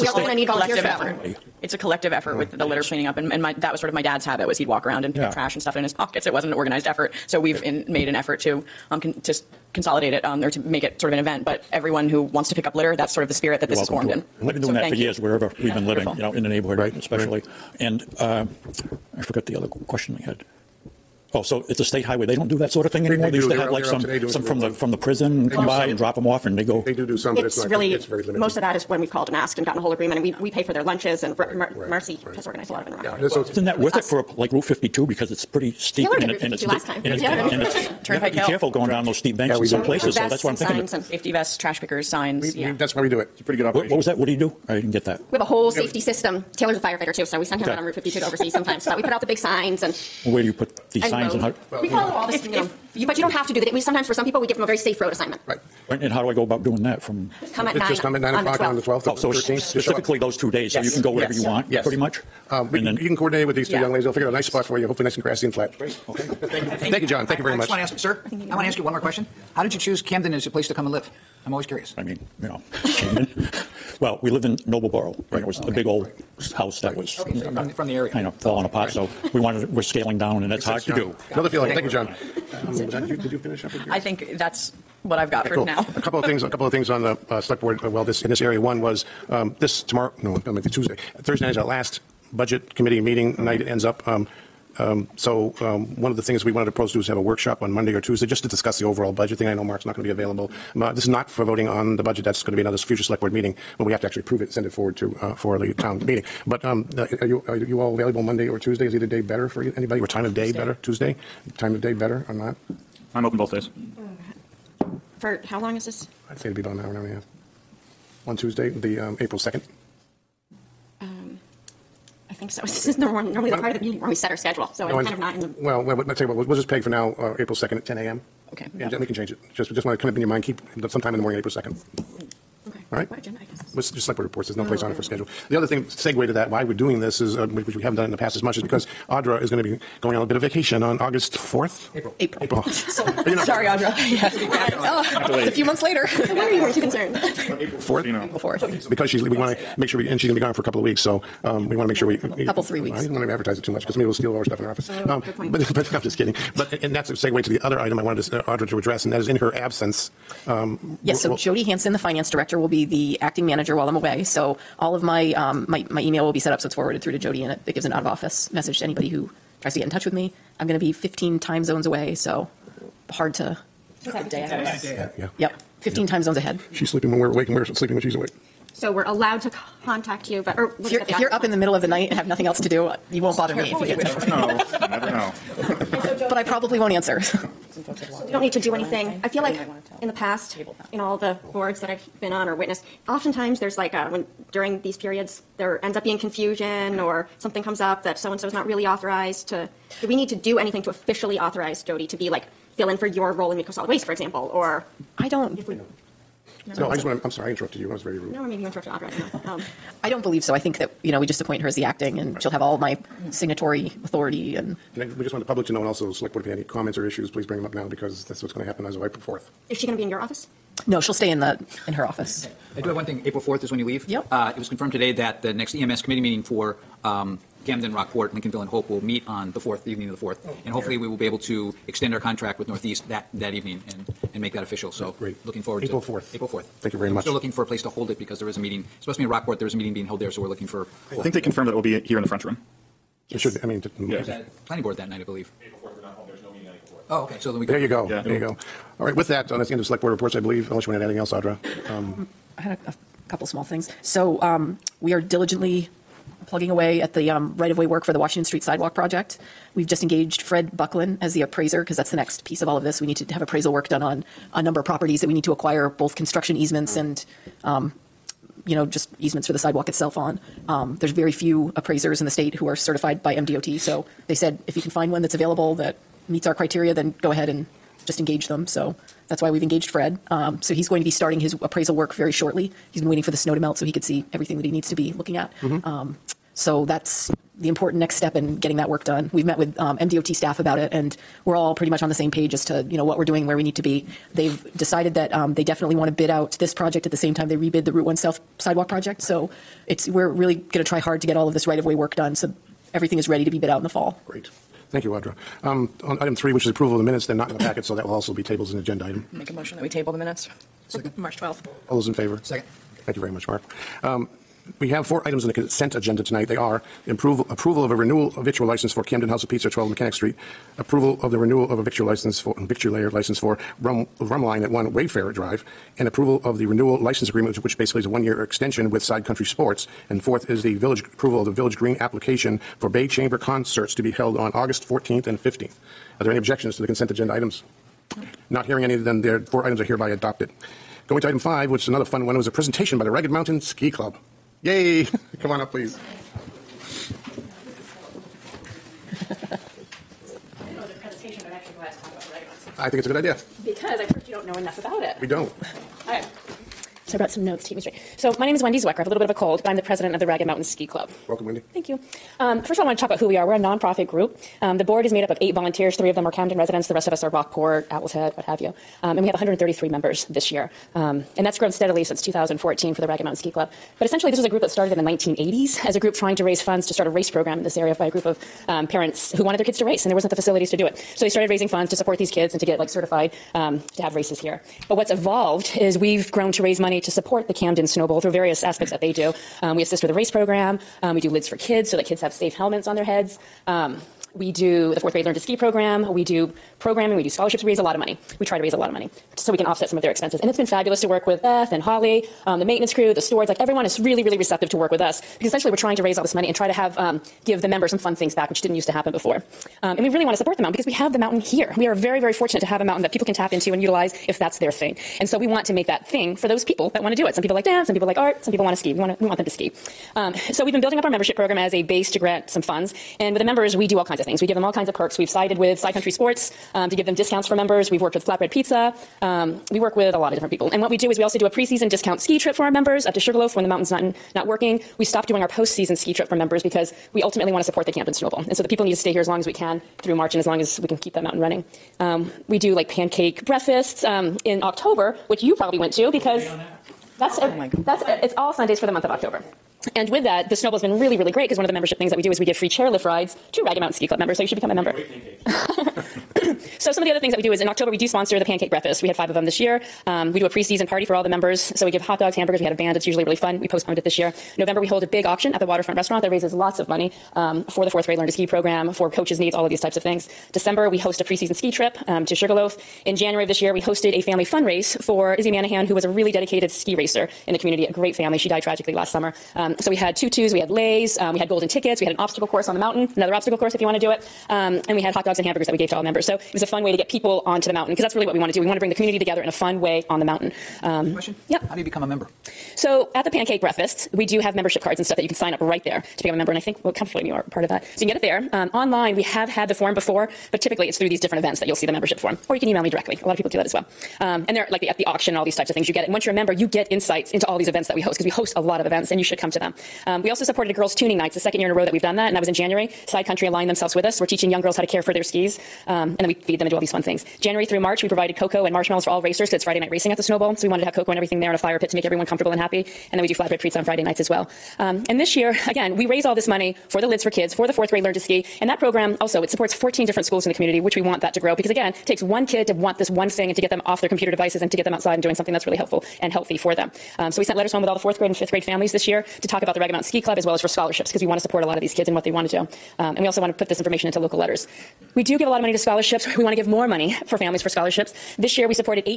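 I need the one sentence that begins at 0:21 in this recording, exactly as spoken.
Oh, so it's a state highway.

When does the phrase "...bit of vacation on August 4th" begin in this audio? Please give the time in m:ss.
2:20.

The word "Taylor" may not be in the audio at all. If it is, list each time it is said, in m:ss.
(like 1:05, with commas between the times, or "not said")
0:36, 0:46.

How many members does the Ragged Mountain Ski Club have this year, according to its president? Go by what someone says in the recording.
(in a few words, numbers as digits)
133.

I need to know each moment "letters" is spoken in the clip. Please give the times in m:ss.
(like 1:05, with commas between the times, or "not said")
8:57, 9:04.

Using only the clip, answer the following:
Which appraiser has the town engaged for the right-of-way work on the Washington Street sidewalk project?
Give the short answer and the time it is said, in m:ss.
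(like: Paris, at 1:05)
Fred Buckland, at 4:20.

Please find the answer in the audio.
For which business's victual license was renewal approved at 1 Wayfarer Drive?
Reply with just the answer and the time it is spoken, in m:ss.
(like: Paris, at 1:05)
Rumline, at 5:24.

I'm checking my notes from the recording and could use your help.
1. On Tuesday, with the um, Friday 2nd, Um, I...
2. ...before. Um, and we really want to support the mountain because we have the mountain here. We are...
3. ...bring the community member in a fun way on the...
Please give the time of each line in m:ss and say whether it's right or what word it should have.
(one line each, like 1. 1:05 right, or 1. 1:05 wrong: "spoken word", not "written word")
1. 1:58 wrong: "April", not "Friday"
2. 6:49 right
3. 8:08 wrong: "together", not "member".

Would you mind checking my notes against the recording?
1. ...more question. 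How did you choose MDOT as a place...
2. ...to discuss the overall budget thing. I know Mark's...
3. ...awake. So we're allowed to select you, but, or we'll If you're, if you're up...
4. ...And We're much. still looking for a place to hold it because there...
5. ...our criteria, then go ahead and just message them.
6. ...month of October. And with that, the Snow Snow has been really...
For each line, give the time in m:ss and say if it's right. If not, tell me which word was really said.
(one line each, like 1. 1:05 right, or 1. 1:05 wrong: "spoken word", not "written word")
1. 1:08 wrong: "Camden", not "MDOT"
2. 1:38 right
3. 2:58 wrong: "contact", not "select"
4. 3:57 right
5. 4:36 wrong: "engage", not "message"
6. 7:28 wrong: "Bowl", not "Snow".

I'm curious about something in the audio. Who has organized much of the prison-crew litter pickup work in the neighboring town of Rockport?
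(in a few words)
Marcy.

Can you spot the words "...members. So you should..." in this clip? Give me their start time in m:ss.
7:34.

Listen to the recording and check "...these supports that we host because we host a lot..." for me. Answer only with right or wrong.
wrong.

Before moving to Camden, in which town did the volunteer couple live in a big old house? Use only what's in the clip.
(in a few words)
Nobleboro.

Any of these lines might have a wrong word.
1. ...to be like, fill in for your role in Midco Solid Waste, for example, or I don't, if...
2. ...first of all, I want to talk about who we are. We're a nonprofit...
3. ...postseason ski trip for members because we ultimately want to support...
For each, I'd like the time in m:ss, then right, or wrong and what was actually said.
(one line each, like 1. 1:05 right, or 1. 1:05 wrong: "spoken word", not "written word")
1. 3:22 right
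2. 6:02 right
3. 7:15 right.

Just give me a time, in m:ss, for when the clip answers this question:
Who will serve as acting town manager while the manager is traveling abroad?
2:41.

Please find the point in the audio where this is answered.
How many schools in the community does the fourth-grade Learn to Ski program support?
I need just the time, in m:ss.
8:49.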